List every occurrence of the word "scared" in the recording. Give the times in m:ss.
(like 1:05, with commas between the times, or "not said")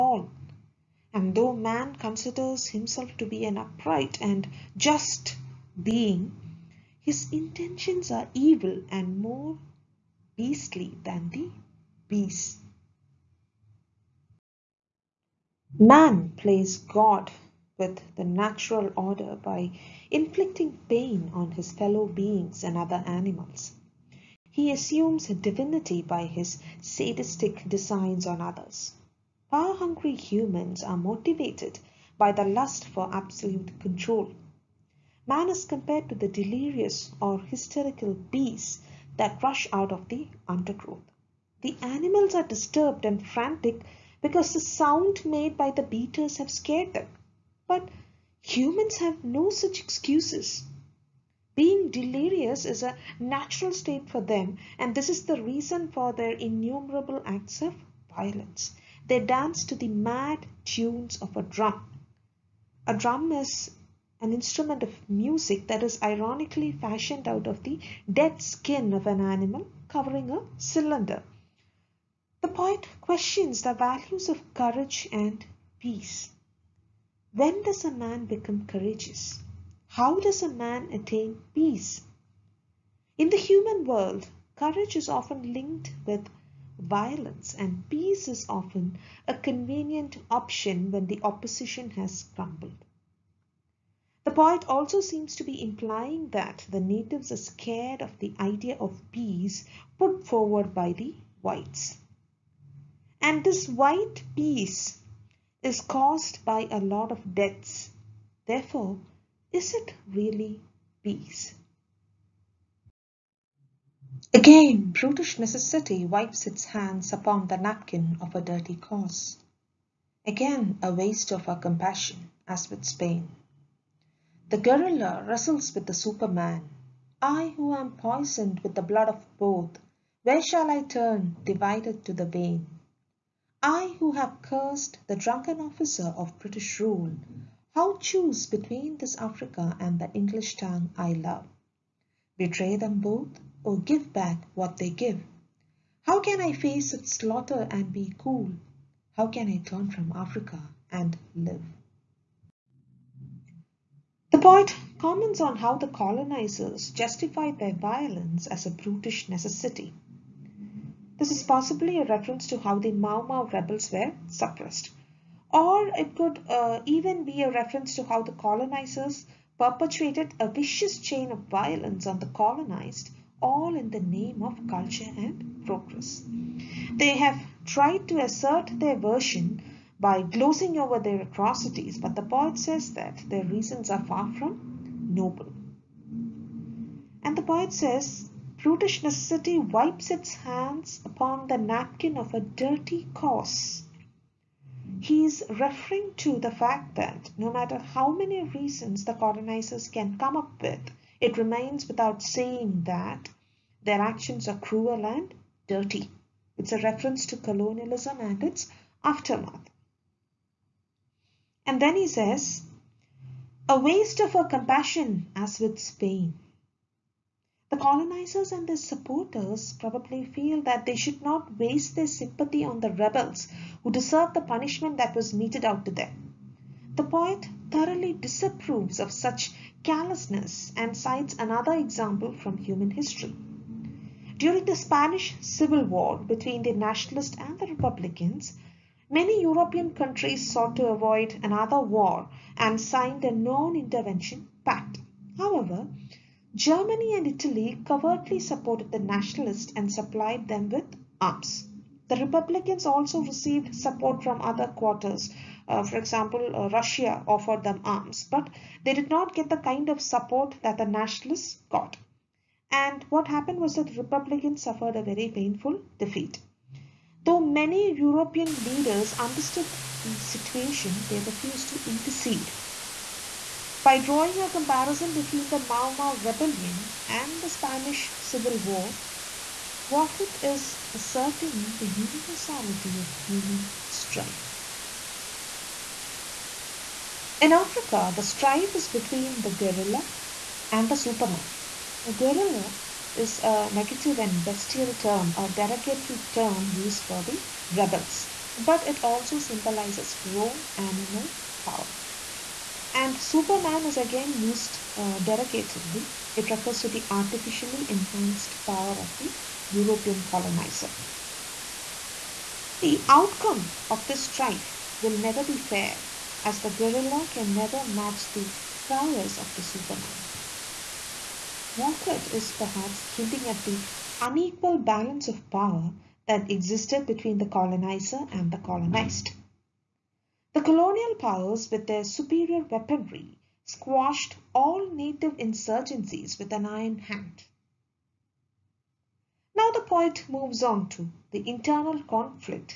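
0:46, 1:37.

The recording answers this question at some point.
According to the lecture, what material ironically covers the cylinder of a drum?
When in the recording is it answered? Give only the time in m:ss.
1:08.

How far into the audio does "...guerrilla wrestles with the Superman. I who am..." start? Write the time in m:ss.
2:04.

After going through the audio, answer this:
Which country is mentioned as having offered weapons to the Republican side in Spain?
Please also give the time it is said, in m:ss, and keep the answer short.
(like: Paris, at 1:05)
Russia, at 4:16.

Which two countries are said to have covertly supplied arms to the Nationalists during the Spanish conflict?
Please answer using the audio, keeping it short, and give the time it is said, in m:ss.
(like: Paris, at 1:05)
Germany and Italy, at 4:06.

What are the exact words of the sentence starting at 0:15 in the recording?
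Man plays God with the natural order by inflicting pain on his fellow beings and other animals.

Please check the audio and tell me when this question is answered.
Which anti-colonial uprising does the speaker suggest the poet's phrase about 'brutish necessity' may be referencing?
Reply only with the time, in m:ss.
2:42.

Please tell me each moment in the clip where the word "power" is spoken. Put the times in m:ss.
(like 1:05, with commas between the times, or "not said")
0:29, 5:01, 5:08, 5:25, 5:31.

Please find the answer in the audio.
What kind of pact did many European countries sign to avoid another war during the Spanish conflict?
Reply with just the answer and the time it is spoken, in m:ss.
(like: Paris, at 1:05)
non-intervention pact, at 4:03.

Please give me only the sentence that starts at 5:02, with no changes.
And Superman is again used uh, derogatorily.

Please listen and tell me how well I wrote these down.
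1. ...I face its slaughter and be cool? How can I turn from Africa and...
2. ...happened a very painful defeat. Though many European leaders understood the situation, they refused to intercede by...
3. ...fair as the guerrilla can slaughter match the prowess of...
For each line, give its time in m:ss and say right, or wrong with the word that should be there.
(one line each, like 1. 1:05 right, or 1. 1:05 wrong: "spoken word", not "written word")
1. 2:26 right
2. 4:24 wrong: "suffered", not "happened"
3. 5:15 wrong: "never", not "slaughter".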